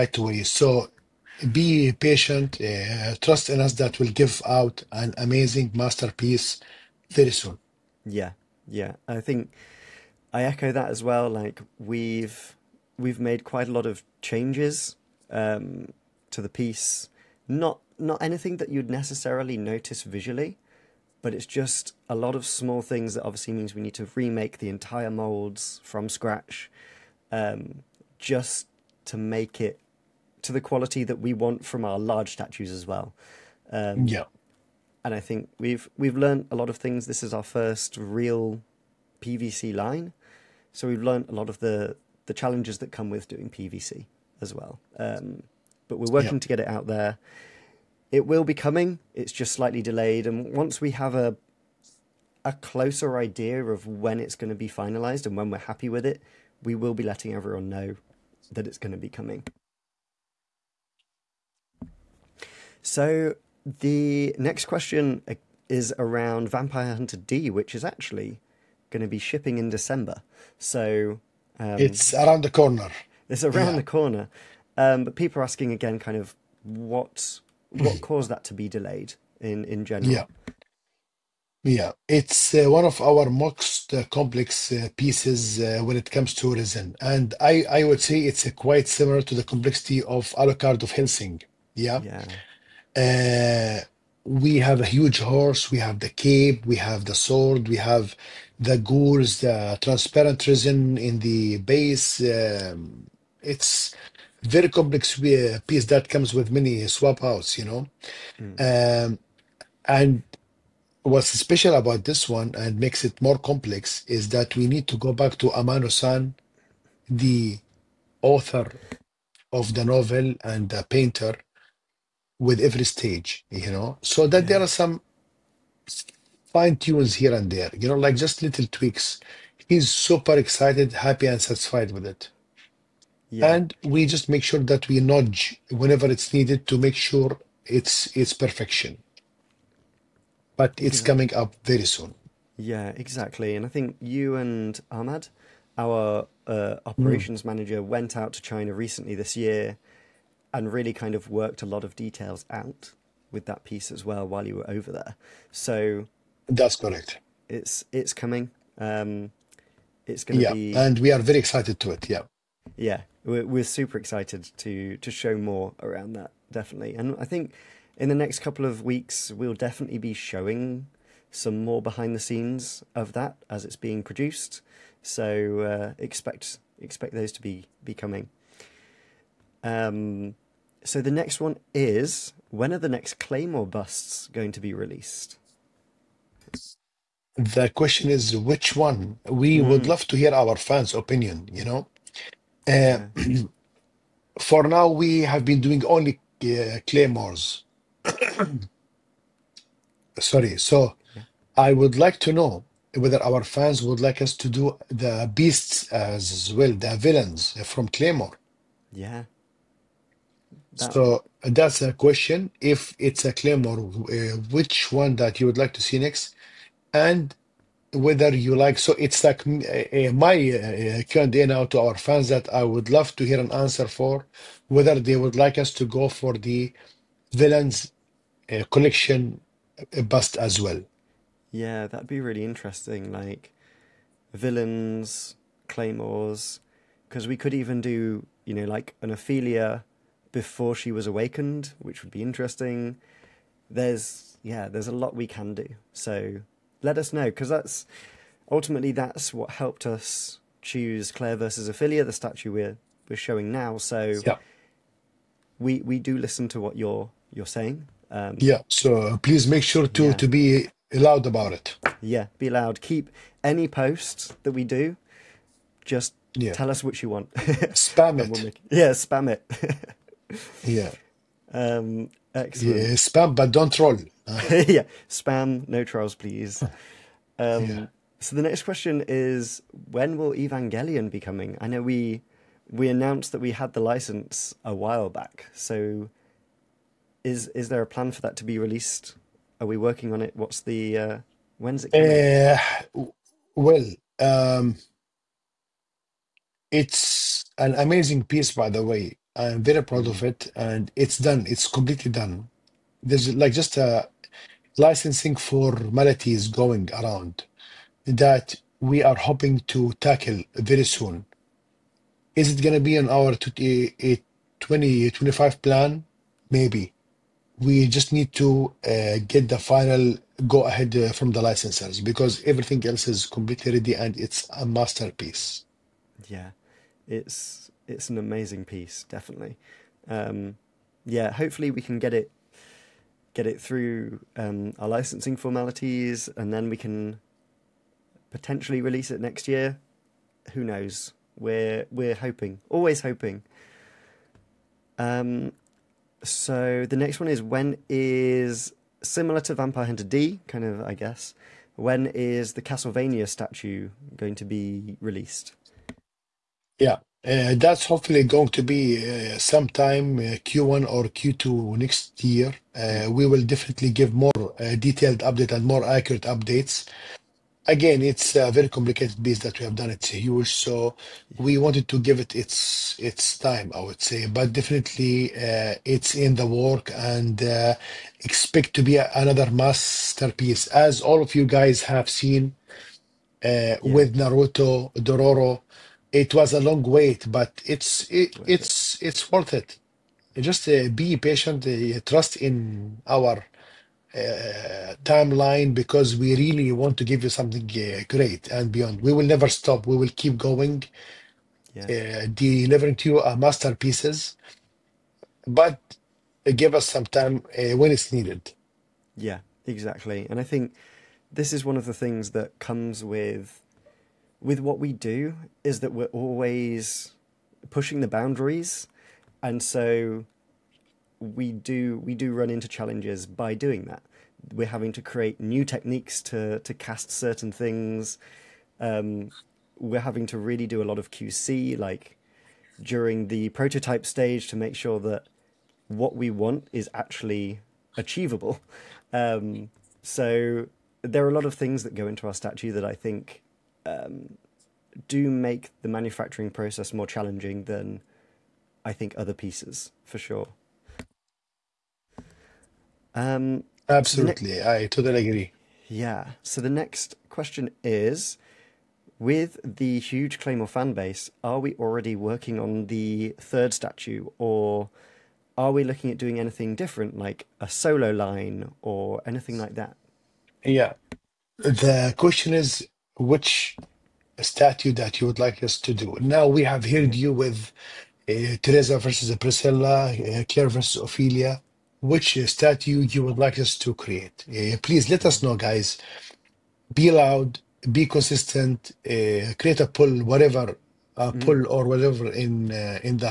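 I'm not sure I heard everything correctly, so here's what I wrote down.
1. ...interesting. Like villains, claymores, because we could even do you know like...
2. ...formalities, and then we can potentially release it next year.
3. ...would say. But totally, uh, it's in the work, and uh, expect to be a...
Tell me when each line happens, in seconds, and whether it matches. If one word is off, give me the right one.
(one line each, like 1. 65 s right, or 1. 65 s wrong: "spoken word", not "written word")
1. 232 s right
2. 335 s right
3. 373 s wrong: "definitely", not "totally".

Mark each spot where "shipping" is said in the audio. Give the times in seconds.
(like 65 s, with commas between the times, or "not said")
69 s.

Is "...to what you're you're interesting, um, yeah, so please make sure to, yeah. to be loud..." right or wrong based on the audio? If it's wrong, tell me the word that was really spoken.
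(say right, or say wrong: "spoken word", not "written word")
wrong: "saying", not "interesting".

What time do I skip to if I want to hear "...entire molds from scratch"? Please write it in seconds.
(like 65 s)
24 s.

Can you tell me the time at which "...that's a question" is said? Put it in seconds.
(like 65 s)
211 s.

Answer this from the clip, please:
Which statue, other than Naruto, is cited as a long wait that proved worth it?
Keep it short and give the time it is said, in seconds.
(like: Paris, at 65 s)
Dororo, at 385 s.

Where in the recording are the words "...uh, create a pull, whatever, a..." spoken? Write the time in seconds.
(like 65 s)
489 s.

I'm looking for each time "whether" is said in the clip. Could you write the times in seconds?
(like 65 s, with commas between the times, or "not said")
202 s, 217 s, 224 s.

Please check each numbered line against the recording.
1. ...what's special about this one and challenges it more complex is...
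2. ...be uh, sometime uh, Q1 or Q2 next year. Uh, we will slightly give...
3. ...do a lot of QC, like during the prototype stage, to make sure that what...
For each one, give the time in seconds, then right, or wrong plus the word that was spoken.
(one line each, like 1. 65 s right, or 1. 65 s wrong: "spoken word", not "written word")
1. 111 s wrong: "makes", not "challenges"
2. 358 s wrong: "definitely", not "slightly"
3. 430 s right.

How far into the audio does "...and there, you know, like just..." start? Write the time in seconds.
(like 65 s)
127 s.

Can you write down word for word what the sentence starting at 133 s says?
And we just make sure that we nudge whenever it's needed to make sure it's it's perfection but it's yeah.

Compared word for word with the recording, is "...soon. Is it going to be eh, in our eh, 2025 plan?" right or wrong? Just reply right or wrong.
right.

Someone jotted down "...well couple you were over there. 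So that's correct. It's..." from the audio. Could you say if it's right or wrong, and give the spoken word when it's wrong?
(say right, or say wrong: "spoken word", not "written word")
wrong: "while", not "couple".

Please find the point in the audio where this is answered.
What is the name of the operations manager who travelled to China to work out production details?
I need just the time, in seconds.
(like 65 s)
144 s.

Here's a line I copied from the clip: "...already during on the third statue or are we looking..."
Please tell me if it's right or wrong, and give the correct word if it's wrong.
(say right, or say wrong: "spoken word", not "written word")
wrong: "working", not "during".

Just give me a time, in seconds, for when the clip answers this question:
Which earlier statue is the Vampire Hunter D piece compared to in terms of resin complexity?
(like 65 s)
90 s.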